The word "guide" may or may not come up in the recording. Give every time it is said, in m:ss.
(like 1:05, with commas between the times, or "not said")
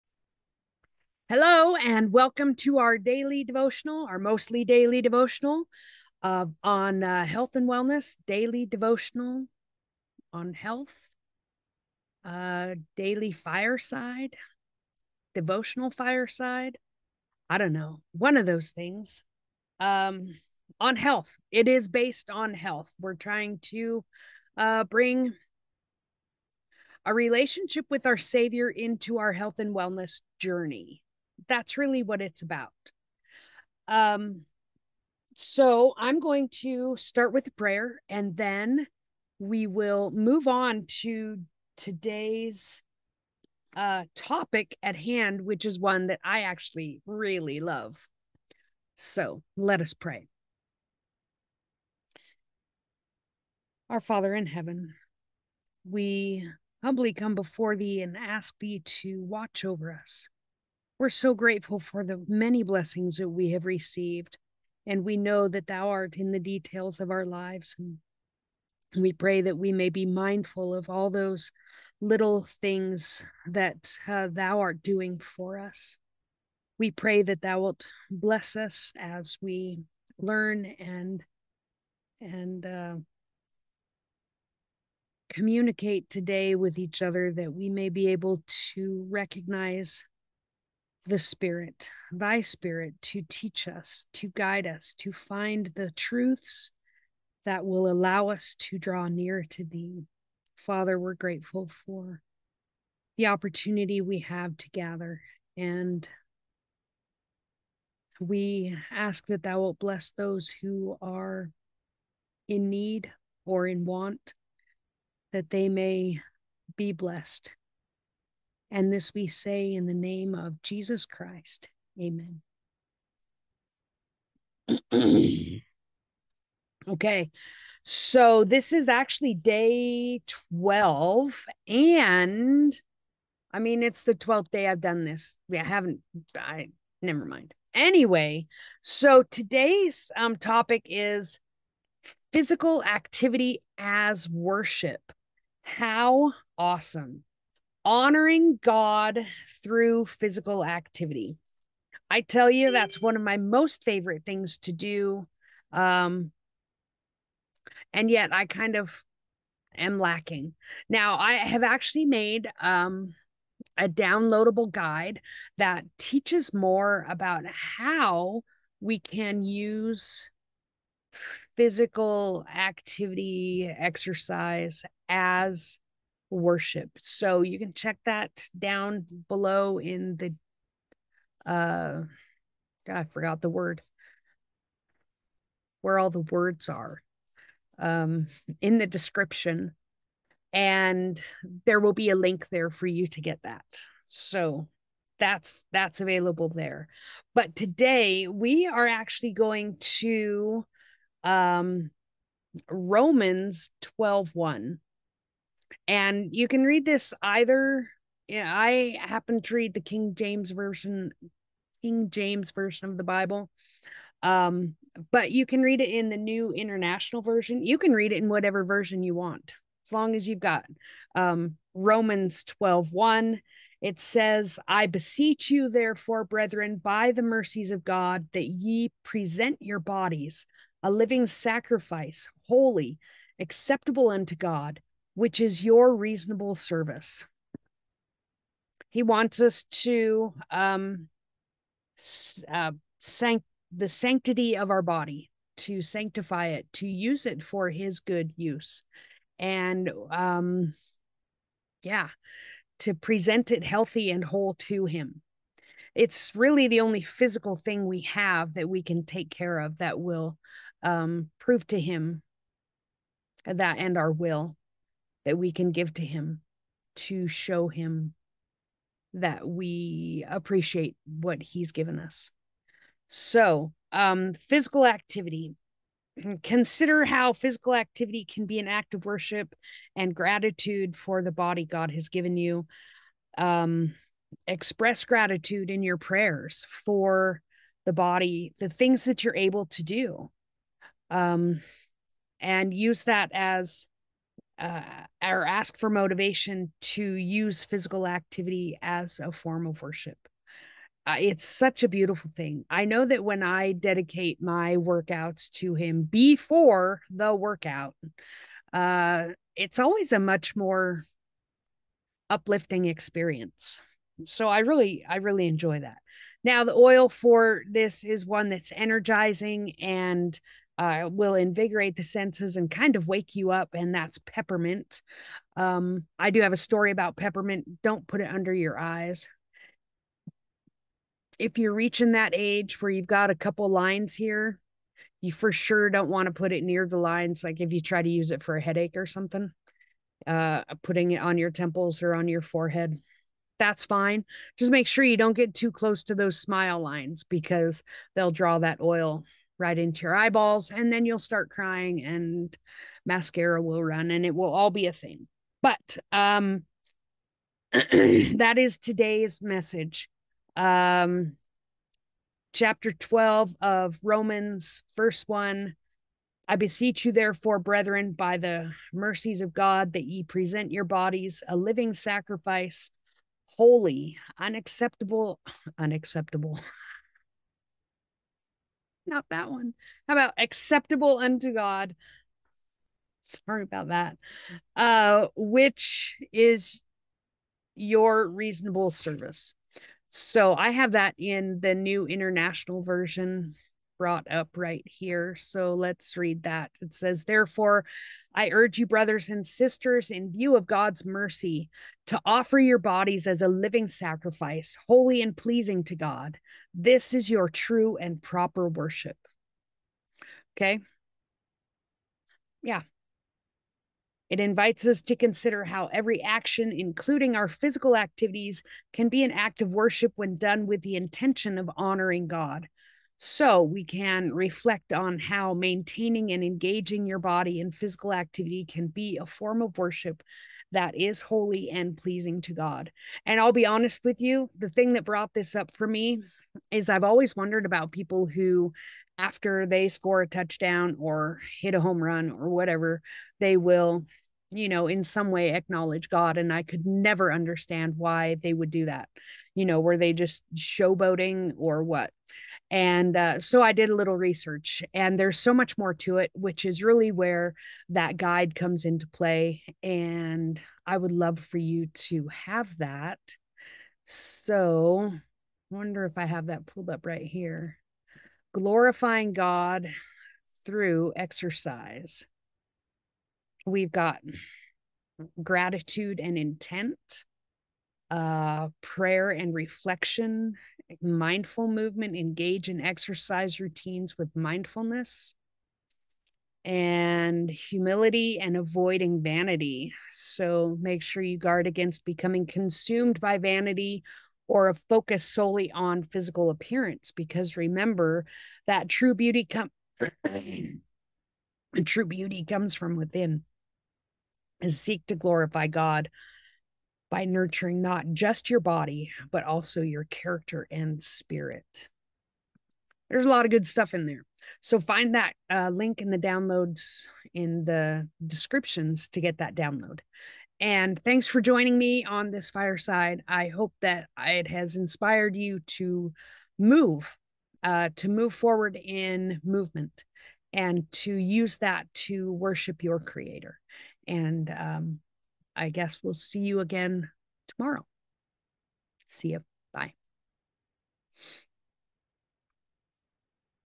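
1:34, 2:44, 7:38.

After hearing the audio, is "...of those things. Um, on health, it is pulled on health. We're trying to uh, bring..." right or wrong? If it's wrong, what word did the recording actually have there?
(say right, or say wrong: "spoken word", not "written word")
wrong: "based", not "pulled".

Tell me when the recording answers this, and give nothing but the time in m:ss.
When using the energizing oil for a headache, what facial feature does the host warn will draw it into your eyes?
5:46.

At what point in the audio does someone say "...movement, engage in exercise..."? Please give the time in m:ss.
8:01.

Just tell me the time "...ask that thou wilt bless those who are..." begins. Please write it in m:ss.
1:48.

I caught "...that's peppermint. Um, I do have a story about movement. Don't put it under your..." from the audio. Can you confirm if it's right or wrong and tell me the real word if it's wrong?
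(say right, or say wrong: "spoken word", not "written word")
wrong: "peppermint", not "movement".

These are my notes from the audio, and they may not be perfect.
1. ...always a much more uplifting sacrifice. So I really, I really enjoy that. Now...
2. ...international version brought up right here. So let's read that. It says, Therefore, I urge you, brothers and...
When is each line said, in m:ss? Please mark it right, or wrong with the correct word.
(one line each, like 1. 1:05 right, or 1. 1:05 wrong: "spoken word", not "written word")
1. 5:09 wrong: "experience", not "sacrifice"
2. 6:32 right.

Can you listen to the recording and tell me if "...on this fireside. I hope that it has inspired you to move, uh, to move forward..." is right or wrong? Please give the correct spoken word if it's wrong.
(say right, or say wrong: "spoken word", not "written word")
right.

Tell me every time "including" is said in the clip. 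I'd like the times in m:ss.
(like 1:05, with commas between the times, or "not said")
6:56.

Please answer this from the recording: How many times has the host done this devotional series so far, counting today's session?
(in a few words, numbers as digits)
12.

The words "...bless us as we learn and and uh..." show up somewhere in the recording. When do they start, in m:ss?
1:18.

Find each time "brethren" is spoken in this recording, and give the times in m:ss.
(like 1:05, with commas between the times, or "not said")
3:46, 6:07.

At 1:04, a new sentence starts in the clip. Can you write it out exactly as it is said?
And we know that thou art in the details of our lives.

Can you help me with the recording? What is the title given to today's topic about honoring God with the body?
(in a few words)
Physical activity as worship.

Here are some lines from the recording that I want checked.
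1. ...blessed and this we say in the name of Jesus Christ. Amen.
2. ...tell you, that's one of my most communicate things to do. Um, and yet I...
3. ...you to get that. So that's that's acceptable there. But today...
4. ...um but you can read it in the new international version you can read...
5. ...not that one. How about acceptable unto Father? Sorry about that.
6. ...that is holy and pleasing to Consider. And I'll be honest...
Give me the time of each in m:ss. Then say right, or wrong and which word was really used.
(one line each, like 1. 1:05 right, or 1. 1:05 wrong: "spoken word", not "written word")
1. 1:56 right
2. 2:32 wrong: "favorite", not "communicate"
3. 3:12 wrong: "available", not "acceptable"
4. 3:34 right
5. 6:19 wrong: "God", not "Father"
6. 7:10 wrong: "God", not "Consider".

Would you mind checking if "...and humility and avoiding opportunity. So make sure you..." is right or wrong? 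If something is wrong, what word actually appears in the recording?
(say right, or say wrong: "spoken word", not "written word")
wrong: "vanity", not "opportunity".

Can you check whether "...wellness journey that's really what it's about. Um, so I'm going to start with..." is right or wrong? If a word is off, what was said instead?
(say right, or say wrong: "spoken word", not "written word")
right.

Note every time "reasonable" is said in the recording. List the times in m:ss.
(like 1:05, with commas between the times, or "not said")
3:55, 6:28.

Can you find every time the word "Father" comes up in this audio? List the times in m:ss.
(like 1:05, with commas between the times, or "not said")
0:54, 1:40.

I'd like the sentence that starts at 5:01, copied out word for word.
Uh, it's such a beautiful thing.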